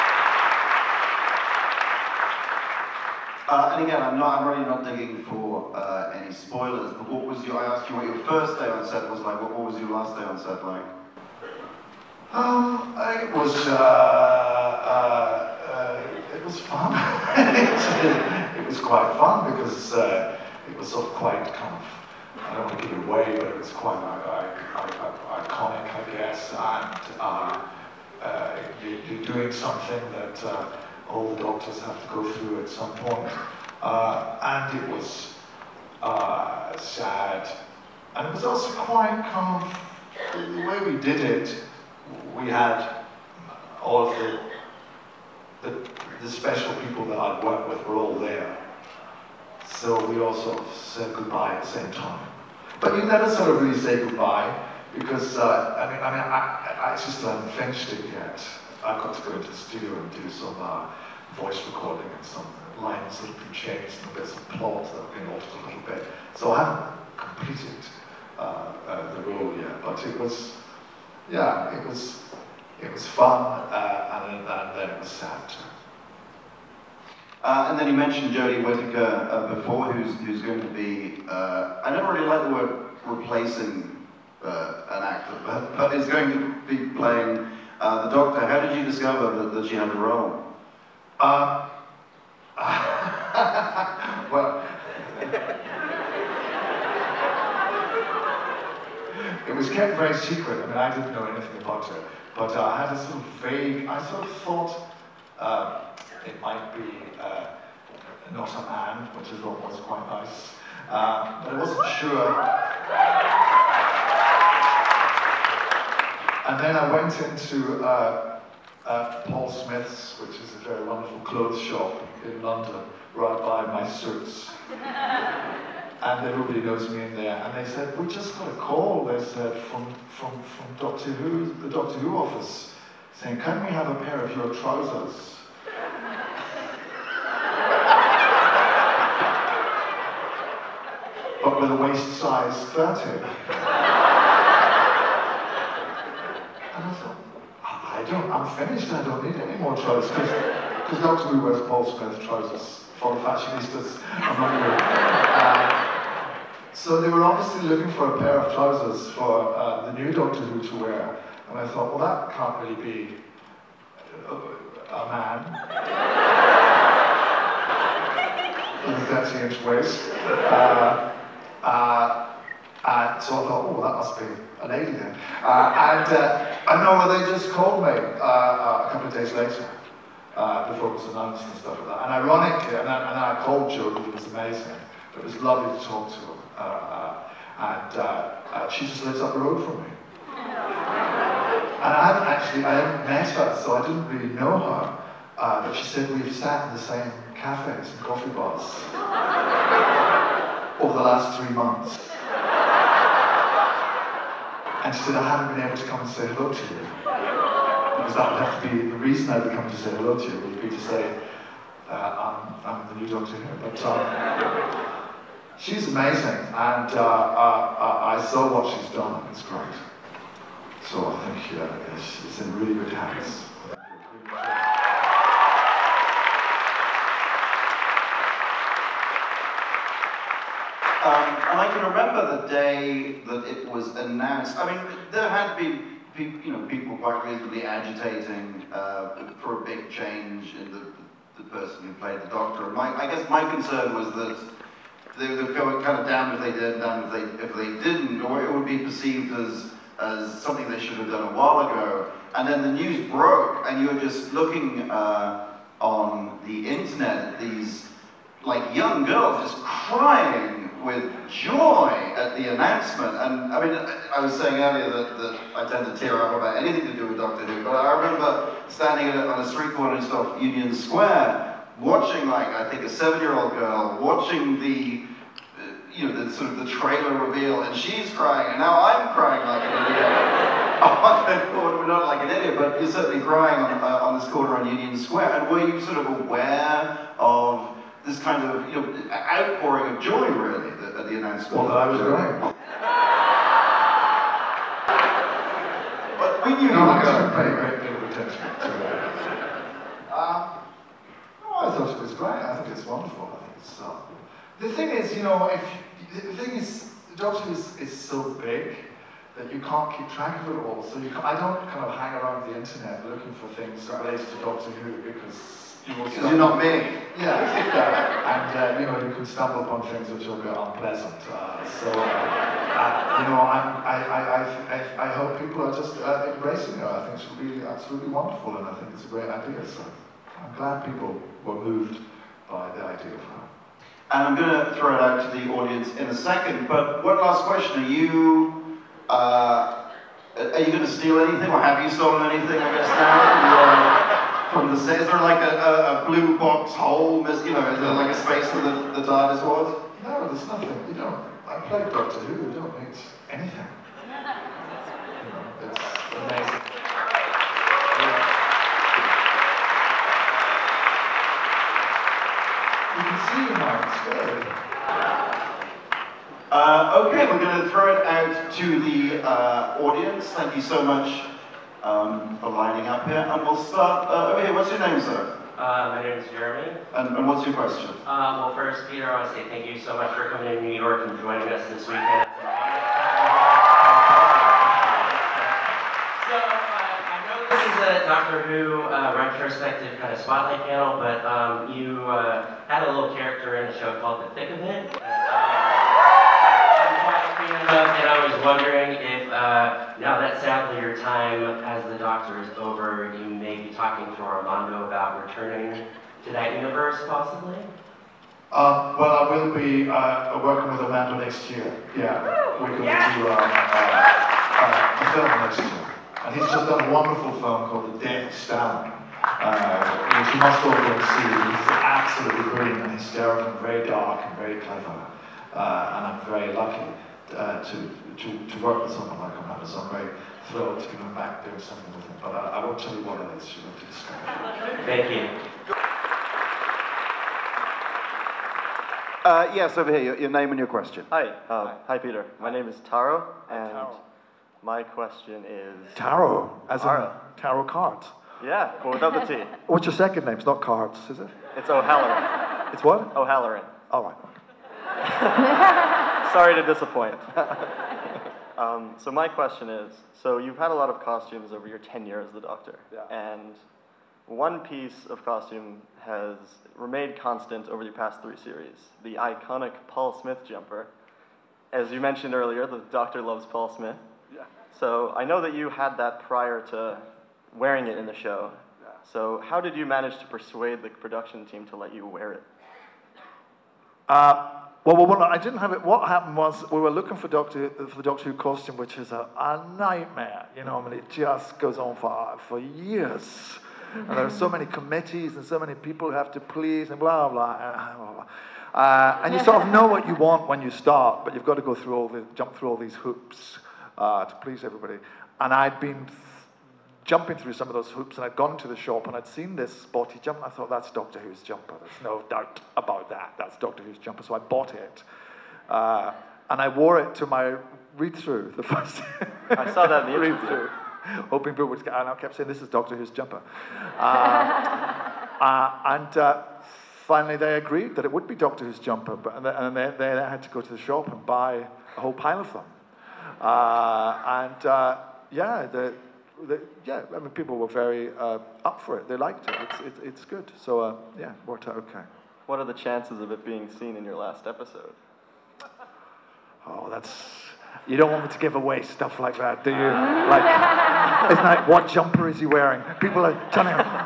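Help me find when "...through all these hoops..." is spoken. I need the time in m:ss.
8:22.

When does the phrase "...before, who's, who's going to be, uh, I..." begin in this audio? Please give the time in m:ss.
1:19.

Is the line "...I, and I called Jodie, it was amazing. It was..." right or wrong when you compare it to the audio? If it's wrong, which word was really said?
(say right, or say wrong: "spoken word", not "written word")
wrong: "Julie", not "Jodie".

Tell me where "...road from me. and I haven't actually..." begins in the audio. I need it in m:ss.
3:09.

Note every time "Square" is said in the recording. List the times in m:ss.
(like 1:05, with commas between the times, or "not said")
4:30, 4:44.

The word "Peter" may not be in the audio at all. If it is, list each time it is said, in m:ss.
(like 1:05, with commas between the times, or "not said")
6:18, 7:21.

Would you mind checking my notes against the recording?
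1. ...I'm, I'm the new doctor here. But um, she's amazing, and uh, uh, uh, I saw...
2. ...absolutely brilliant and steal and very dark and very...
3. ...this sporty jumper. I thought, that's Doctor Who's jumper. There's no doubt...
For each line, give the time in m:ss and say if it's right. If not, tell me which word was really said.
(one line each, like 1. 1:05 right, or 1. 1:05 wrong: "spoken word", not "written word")
1. 3:31 right
2. 7:01 wrong: "hysterical", not "steal"
3. 8:29 right.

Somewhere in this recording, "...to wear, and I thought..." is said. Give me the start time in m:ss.
2:40.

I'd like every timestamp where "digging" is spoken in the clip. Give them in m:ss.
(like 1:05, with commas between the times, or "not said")
0:04.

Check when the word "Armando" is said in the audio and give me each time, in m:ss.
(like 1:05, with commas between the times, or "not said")
6:44, 6:50, 7:09.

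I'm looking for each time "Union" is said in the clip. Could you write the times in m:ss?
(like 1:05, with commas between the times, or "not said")
4:30, 4:44.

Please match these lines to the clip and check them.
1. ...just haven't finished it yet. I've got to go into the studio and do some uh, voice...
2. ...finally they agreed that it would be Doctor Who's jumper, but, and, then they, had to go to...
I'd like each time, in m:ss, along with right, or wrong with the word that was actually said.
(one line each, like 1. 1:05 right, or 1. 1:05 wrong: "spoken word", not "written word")
1. 0:56 right
2. 8:47 right.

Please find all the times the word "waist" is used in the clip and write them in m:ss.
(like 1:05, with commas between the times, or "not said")
2:21, 2:49.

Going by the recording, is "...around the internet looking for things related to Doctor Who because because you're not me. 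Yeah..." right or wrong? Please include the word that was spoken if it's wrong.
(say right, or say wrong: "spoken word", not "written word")
right.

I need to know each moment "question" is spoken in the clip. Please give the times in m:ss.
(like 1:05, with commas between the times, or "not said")
5:37, 6:17, 7:20, 7:24, 7:39.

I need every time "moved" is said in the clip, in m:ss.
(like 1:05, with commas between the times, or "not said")
5:31.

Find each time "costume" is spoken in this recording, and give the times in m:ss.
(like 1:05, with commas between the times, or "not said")
7:41, 7:45, 8:08.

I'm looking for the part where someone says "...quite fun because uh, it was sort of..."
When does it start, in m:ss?
0:18.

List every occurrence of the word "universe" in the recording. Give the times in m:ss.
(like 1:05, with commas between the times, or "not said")
6:46.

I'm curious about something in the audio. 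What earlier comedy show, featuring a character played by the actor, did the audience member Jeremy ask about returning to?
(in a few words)
The Thick of It.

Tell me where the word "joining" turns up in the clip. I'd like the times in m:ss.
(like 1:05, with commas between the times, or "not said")
6:21.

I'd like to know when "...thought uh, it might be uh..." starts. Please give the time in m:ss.
1:44.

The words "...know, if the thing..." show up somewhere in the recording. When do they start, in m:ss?
5:05.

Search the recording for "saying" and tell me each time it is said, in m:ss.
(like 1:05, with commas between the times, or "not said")
2:13, 4:24, 8:42.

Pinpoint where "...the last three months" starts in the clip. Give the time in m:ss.
3:20.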